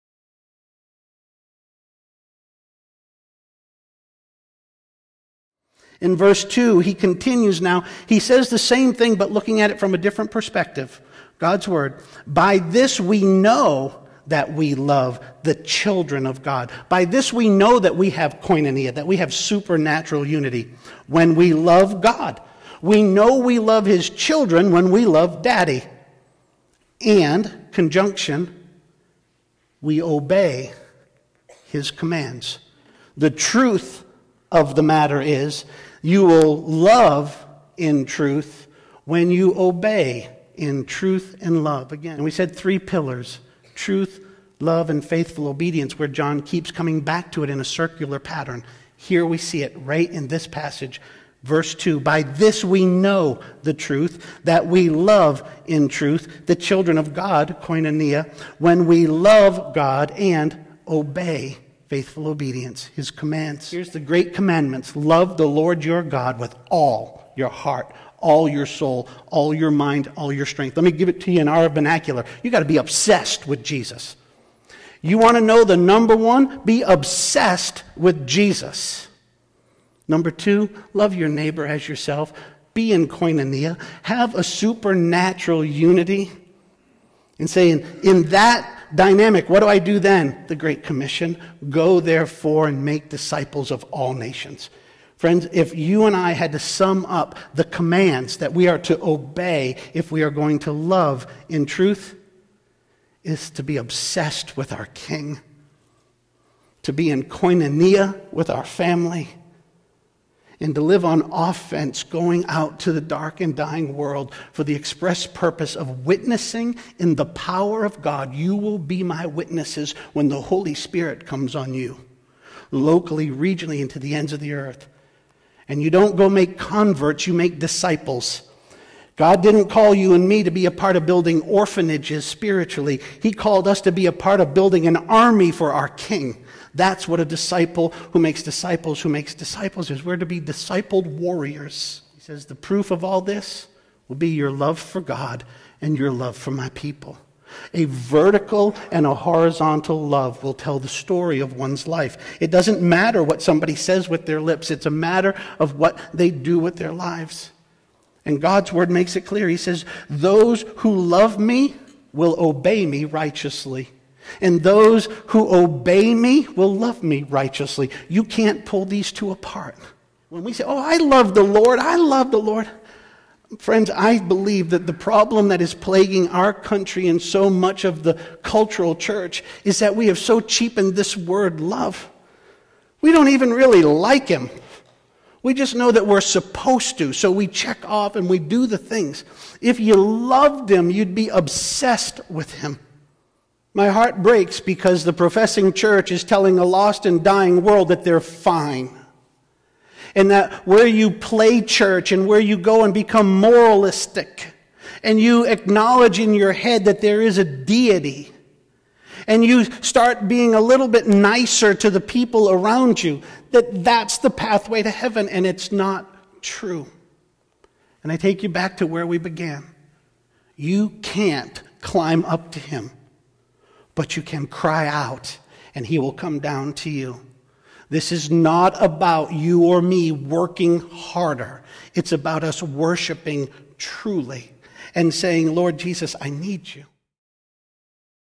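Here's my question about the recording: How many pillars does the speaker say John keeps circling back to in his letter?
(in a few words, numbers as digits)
3.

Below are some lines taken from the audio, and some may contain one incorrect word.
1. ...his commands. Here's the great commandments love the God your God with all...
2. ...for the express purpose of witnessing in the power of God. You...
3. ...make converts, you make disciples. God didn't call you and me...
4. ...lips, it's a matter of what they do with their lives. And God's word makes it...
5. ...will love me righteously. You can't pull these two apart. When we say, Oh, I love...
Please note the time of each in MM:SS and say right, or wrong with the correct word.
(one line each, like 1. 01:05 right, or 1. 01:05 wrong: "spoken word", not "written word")
1. 01:02 wrong: "Lord", not "God"
2. 01:54 right
3. 02:06 right
4. 02:34 right
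5. 02:46 right.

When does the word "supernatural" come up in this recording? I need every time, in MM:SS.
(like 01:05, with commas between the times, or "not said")
00:19, 01:24.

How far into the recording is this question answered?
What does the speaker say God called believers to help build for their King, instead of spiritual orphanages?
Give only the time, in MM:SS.
02:14.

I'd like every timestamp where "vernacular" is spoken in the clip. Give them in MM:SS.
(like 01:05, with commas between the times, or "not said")
01:11.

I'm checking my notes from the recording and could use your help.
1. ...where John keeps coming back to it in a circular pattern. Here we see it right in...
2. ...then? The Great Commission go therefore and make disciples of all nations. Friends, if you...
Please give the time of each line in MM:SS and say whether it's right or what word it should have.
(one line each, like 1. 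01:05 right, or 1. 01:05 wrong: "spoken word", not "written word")
1. 00:45 right
2. 01:29 right.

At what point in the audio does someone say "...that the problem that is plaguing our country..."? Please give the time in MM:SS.
02:54.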